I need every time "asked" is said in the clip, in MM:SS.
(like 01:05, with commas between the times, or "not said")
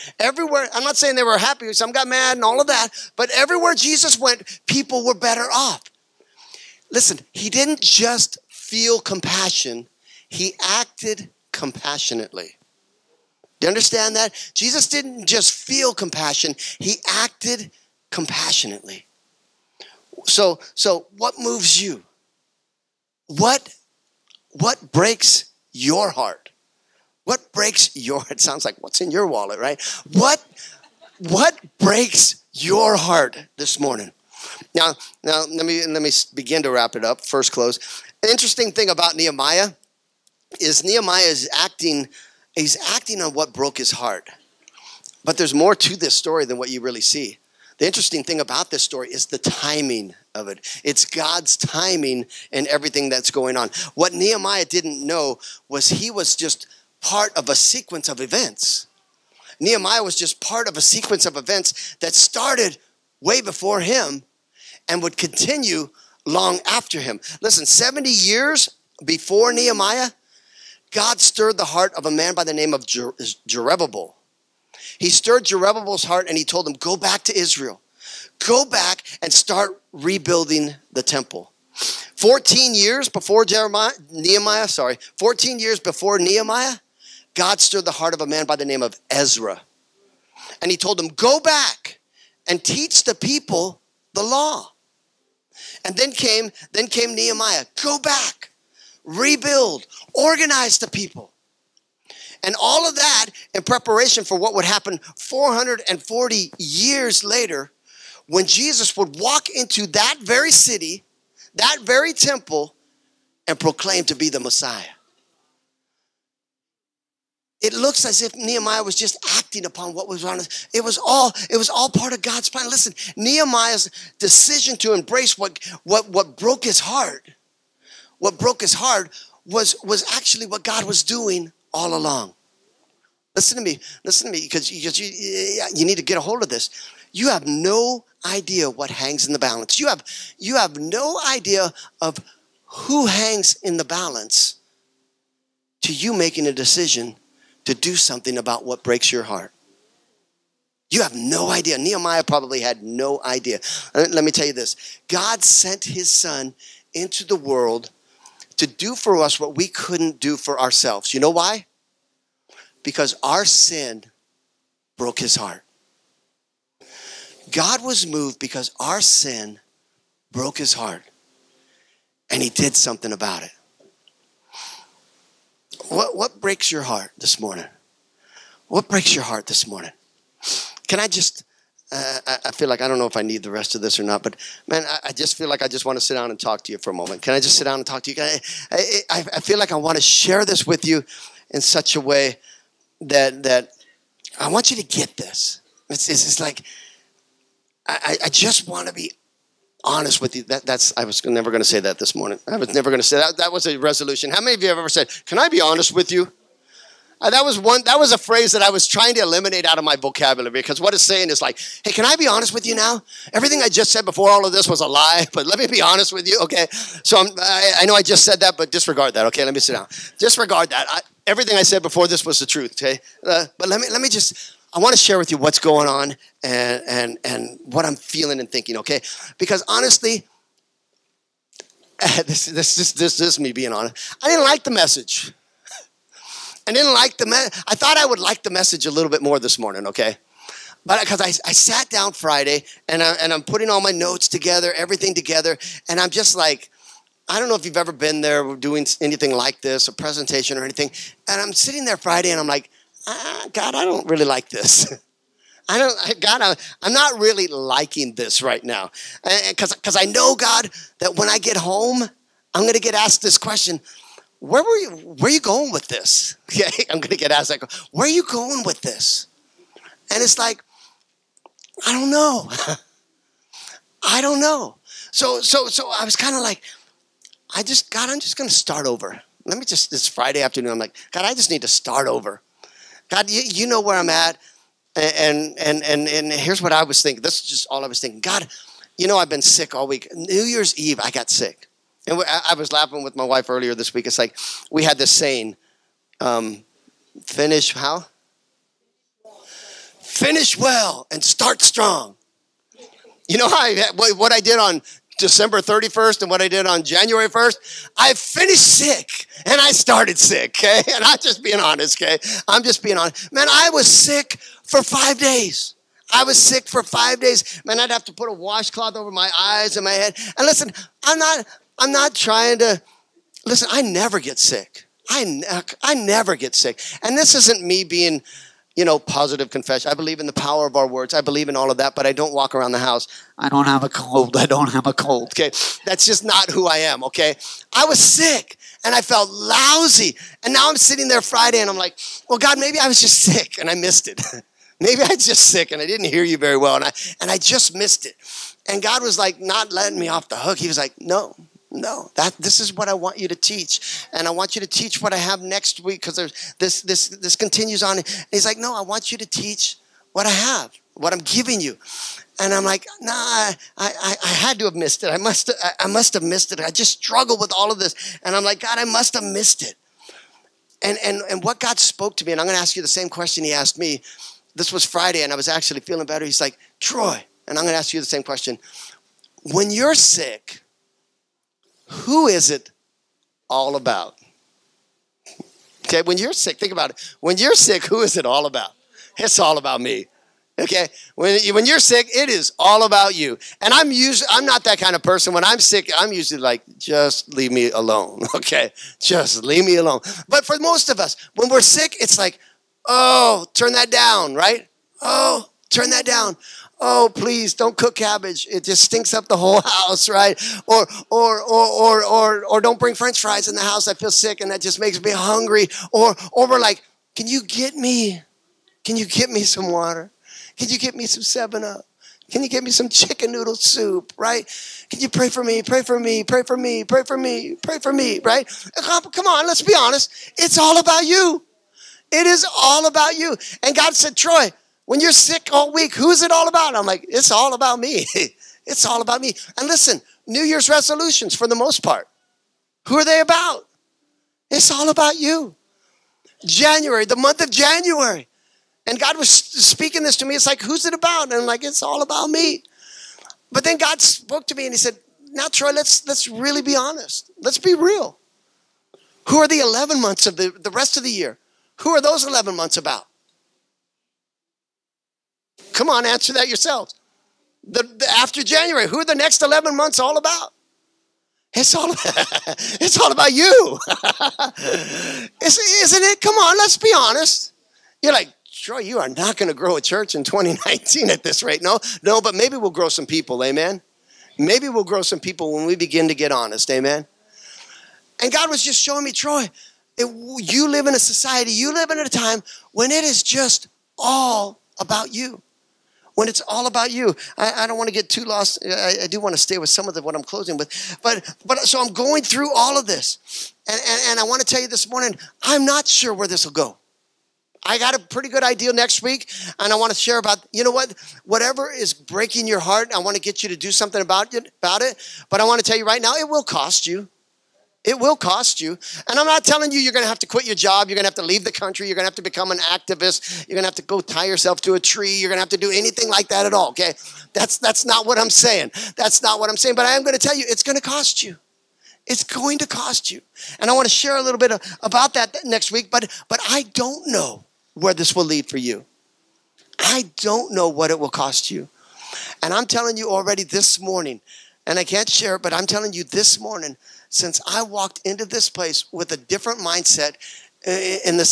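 04:22, 04:27, 06:13.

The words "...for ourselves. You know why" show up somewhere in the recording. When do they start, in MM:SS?
02:40.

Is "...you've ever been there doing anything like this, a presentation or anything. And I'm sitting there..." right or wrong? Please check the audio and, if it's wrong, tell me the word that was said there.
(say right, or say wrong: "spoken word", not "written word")
right.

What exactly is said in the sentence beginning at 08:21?
But, but so I'm going through all of this.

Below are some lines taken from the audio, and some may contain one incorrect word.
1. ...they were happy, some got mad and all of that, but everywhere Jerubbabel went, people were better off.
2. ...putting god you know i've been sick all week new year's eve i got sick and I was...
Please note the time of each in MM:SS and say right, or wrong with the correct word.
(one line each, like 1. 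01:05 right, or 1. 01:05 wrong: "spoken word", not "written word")
1. 00:01 wrong: "Jesus", not "Jerubbabel"
2. 04:48 wrong: "thinking", not "putting".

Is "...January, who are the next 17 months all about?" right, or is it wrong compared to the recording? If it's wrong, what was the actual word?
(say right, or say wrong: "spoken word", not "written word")
wrong: "11", not "17".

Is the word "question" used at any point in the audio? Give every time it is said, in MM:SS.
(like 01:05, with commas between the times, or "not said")
04:23, 06:13, 06:18.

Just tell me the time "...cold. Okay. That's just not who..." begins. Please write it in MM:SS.
05:34.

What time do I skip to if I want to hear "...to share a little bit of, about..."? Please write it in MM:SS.
08:53.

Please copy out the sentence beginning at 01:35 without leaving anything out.
And then came, then came Nehemiah, Go back rebuild, organize the people.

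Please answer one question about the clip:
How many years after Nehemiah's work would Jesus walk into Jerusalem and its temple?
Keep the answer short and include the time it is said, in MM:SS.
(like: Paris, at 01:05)
440, at 01:45.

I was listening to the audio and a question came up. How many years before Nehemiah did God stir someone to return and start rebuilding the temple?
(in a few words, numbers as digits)
70.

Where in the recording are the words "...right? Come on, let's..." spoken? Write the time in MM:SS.
07:08.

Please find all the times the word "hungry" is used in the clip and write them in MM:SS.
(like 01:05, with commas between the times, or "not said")
06:55.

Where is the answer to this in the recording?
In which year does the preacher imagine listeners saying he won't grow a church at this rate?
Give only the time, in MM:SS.
08:00.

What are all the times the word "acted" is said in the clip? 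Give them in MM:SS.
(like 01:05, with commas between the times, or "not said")
00:10, 00:17.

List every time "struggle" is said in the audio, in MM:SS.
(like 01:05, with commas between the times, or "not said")
06:06.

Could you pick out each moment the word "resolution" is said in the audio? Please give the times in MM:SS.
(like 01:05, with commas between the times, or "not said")
03:23, 07:20.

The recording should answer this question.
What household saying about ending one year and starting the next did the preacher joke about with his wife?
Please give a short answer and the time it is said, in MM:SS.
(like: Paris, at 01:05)
Finish well and start strong, at 05:00.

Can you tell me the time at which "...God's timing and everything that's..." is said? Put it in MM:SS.
00:51.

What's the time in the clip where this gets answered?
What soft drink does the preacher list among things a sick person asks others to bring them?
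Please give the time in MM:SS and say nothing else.
07:01.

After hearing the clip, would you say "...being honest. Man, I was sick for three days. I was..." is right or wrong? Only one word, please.
wrong.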